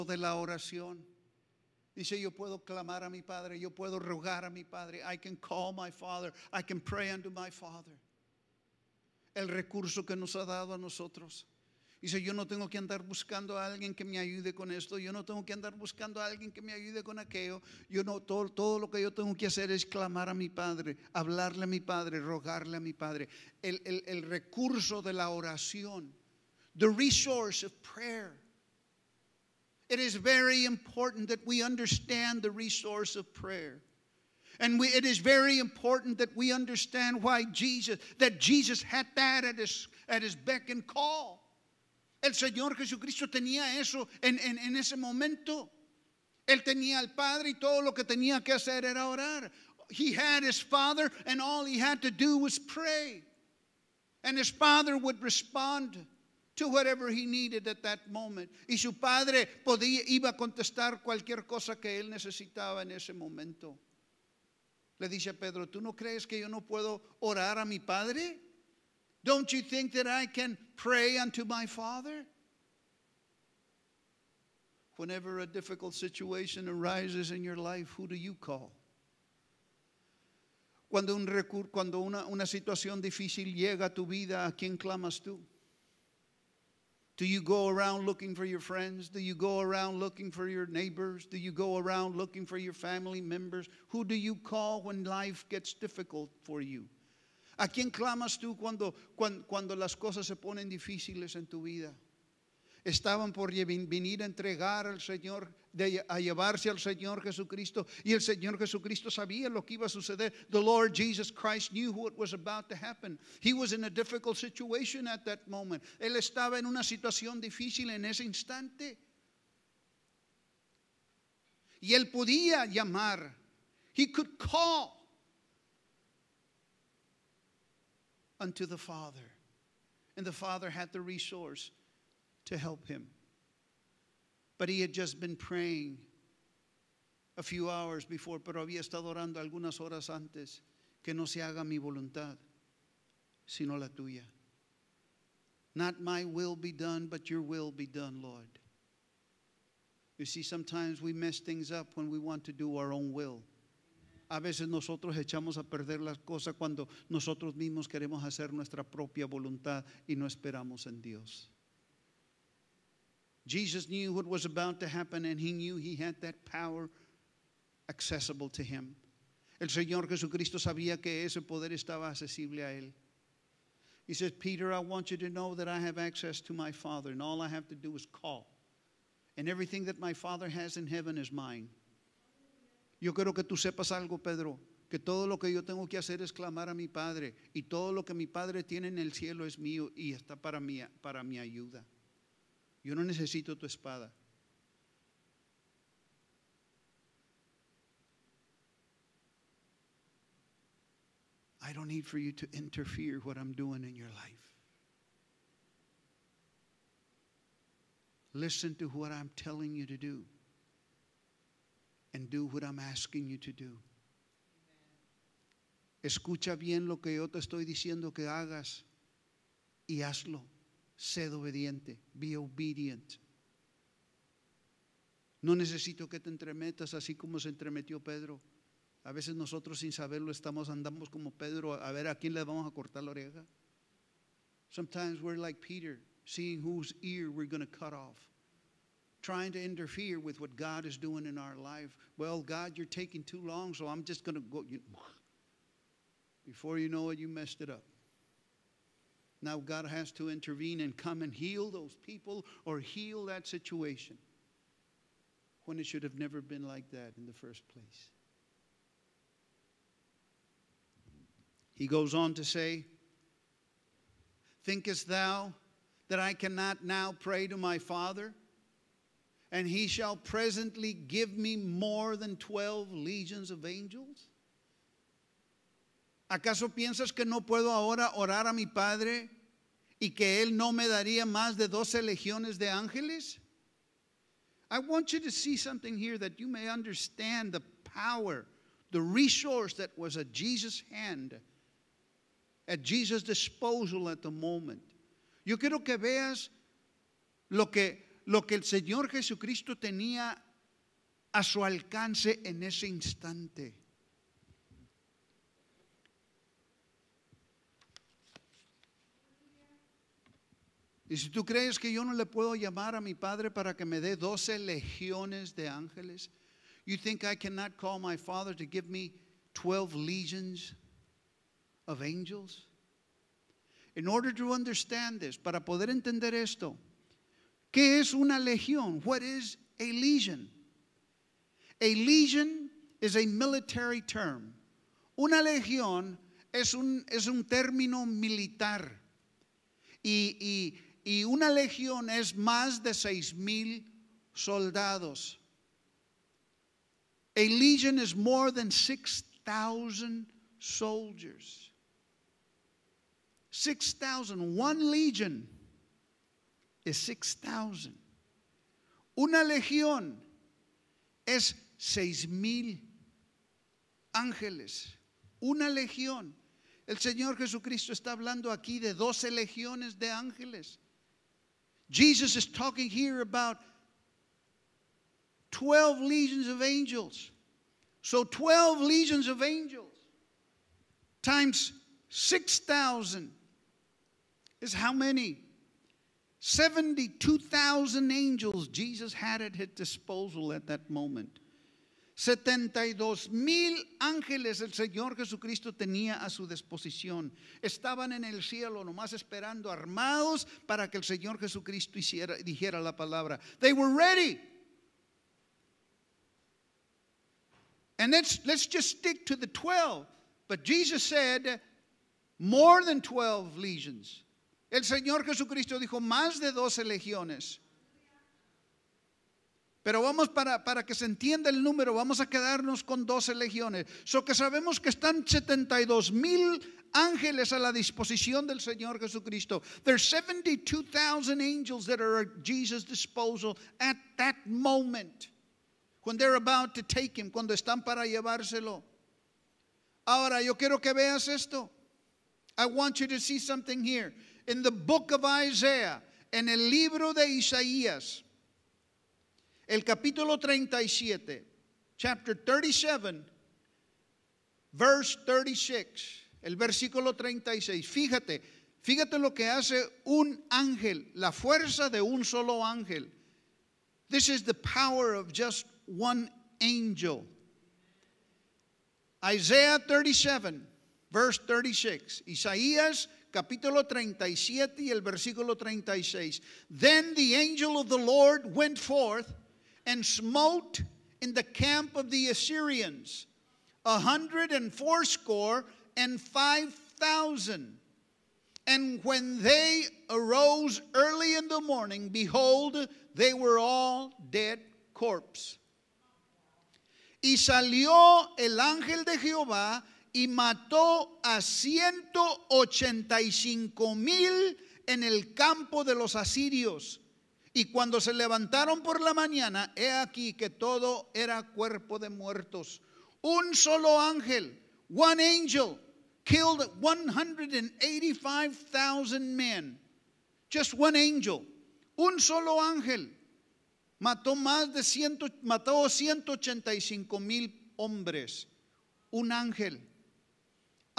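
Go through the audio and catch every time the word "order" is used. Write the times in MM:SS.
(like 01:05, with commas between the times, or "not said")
05:24.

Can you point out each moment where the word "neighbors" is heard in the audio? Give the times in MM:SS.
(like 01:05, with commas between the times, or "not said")
01:30.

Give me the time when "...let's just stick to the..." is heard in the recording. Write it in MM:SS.
06:48.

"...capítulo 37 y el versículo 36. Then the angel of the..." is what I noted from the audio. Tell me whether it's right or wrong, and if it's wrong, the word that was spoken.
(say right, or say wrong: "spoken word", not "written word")
right.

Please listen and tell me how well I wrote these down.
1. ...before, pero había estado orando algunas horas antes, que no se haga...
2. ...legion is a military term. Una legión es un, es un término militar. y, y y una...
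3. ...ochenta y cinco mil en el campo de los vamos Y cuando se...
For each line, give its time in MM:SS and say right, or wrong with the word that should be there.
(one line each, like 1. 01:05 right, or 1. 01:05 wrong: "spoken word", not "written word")
1. 02:18 right
2. 05:31 right
3. 08:22 wrong: "asirios", not "vamos".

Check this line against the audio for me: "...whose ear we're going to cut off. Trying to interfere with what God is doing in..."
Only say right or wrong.
right.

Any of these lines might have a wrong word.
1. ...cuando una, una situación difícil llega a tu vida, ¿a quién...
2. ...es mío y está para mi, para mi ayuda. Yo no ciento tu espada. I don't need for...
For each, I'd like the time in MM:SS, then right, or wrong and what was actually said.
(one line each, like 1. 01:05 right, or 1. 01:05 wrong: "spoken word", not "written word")
1. 01:21 right
2. 03:09 wrong: "necesito", not "ciento".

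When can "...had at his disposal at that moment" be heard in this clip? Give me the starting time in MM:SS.
06:29.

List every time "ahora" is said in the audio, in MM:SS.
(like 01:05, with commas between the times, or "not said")
04:37, 07:20.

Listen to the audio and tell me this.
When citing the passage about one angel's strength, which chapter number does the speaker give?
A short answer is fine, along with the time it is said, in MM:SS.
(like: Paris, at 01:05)
37, at 07:31.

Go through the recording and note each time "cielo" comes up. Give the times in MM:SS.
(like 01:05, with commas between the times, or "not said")
03:09, 06:38.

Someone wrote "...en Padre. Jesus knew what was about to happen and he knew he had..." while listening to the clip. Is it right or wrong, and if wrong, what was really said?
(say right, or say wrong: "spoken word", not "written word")
wrong: "Dios", not "Padre".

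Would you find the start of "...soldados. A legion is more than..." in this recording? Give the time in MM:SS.
05:44.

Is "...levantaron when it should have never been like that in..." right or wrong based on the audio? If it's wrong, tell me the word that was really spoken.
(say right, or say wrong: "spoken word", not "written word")
wrong: "situation", not "levantaron".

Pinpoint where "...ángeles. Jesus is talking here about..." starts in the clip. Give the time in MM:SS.
06:10.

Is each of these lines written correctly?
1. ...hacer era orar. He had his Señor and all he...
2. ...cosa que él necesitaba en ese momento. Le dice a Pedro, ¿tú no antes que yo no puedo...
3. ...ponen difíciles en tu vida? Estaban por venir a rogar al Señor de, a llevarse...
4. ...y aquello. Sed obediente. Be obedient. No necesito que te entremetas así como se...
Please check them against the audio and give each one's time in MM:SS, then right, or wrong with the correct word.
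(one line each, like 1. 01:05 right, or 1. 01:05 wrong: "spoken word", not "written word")
1. 00:48 wrong: "Father", not "Señor"
2. 01:01 wrong: "crees", not "antes"
3. 01:40 wrong: "entregar", not "rogar"
4. 03:39 wrong: "hazlo", not "aquello".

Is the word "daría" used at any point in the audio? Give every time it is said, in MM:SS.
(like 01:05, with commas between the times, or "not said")
04:40.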